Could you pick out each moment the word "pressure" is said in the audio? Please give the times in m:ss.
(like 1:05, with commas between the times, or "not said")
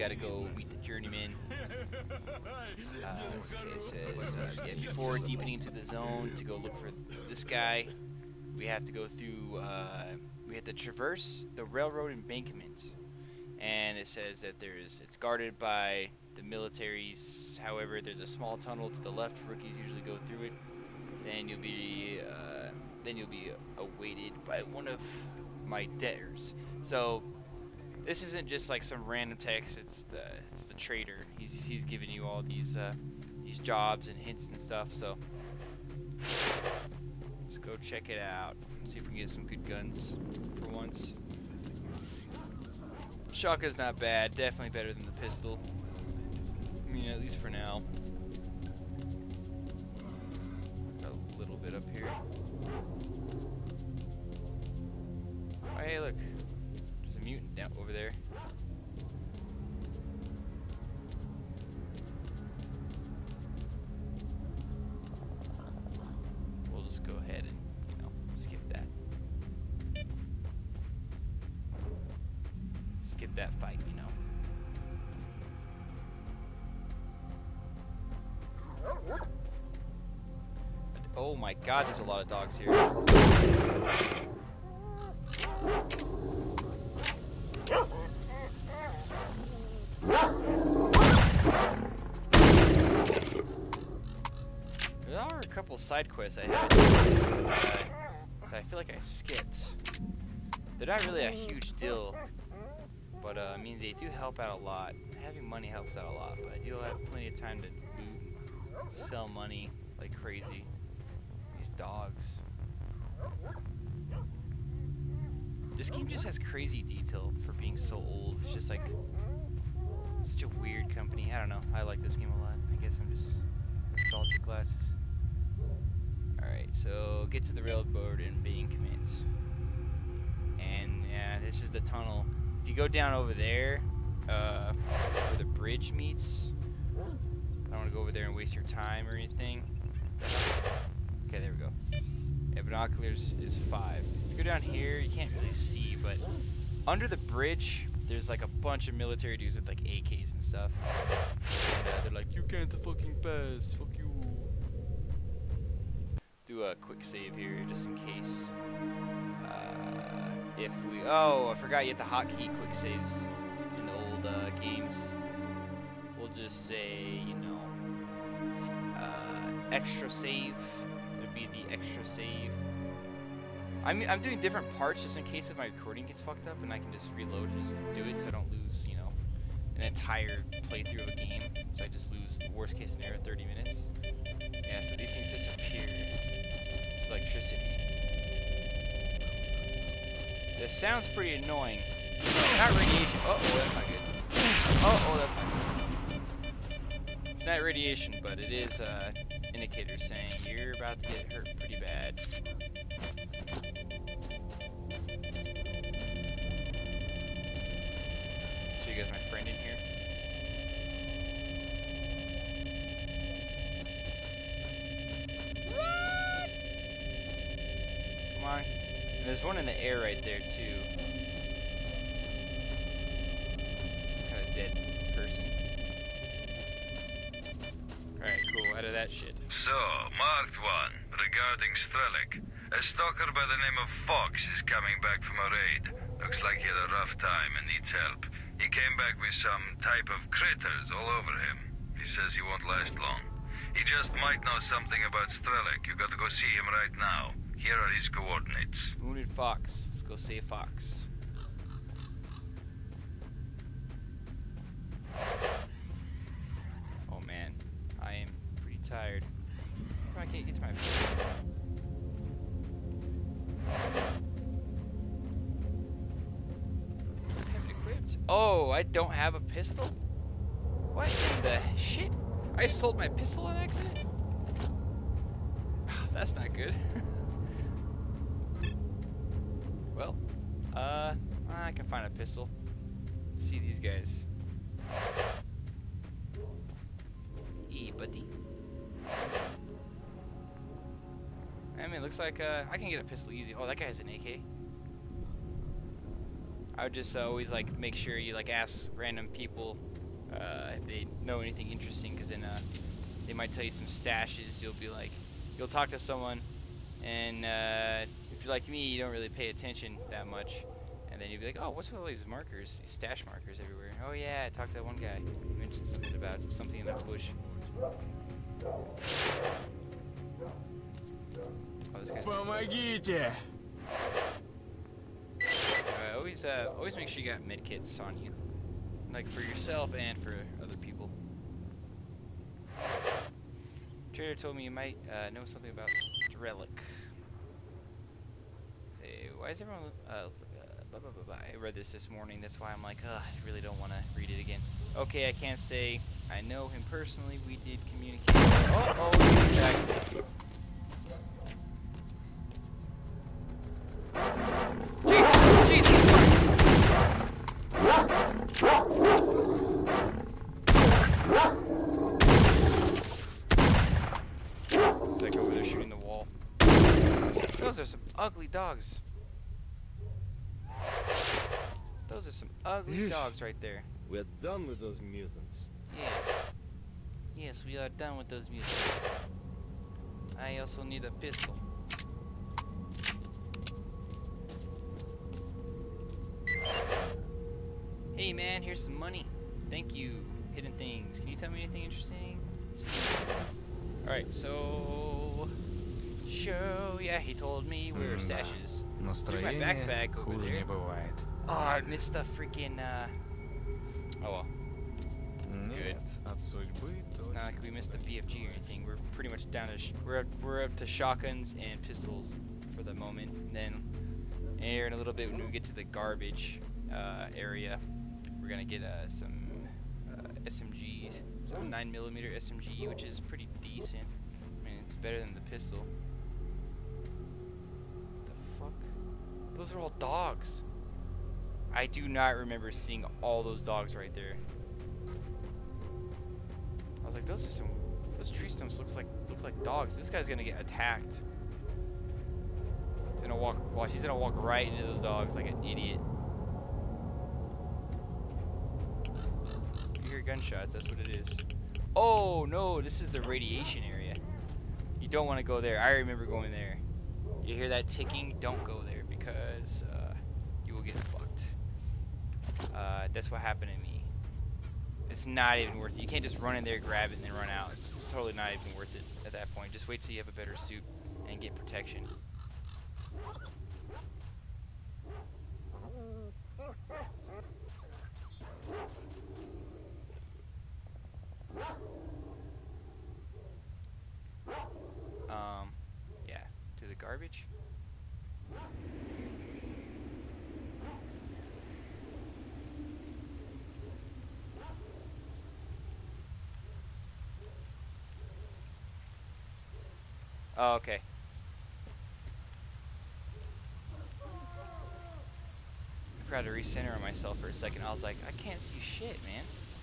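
not said.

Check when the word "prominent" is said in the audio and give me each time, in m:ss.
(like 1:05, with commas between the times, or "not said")
not said.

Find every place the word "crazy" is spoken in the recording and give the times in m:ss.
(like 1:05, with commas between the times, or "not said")
1:50, 1:56.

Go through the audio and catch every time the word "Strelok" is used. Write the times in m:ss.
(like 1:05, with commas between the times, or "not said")
3:51, 4:05.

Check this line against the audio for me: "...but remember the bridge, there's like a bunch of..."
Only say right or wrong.
wrong.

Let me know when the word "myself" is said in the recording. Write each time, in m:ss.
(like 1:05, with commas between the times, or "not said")
8:27.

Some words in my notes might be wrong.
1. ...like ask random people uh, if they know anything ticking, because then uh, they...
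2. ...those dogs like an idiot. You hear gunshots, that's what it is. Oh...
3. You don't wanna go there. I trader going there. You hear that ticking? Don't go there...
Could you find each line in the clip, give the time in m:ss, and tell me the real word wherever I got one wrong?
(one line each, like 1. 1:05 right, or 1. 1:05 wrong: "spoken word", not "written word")
1. 4:58 wrong: "interesting", not "ticking"
2. 7:24 right
3. 7:34 wrong: "remember", not "trader".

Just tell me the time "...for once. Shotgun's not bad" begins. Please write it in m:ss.
0:40.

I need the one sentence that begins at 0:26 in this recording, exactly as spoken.
So this isn't just like some random text.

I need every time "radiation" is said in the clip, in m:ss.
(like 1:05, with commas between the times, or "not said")
3:12, 3:17, 7:33.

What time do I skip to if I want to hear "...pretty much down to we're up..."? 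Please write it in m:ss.
6:49.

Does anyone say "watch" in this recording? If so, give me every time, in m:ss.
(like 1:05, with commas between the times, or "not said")
7:23.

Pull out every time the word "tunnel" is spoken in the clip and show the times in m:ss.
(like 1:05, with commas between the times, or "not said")
0:18, 2:11.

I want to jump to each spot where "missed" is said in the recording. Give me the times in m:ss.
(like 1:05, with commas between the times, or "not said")
6:41, 6:47.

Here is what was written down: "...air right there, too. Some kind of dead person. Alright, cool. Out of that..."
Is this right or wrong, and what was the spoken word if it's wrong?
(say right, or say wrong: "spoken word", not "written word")
right.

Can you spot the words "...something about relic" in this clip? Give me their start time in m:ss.
5:35.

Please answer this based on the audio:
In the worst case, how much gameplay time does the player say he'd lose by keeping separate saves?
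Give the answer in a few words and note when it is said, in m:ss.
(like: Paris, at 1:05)
30 minutes, at 3:03.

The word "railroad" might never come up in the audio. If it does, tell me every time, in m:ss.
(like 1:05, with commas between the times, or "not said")
0:11, 2:07.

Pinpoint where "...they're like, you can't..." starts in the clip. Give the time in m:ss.
2:32.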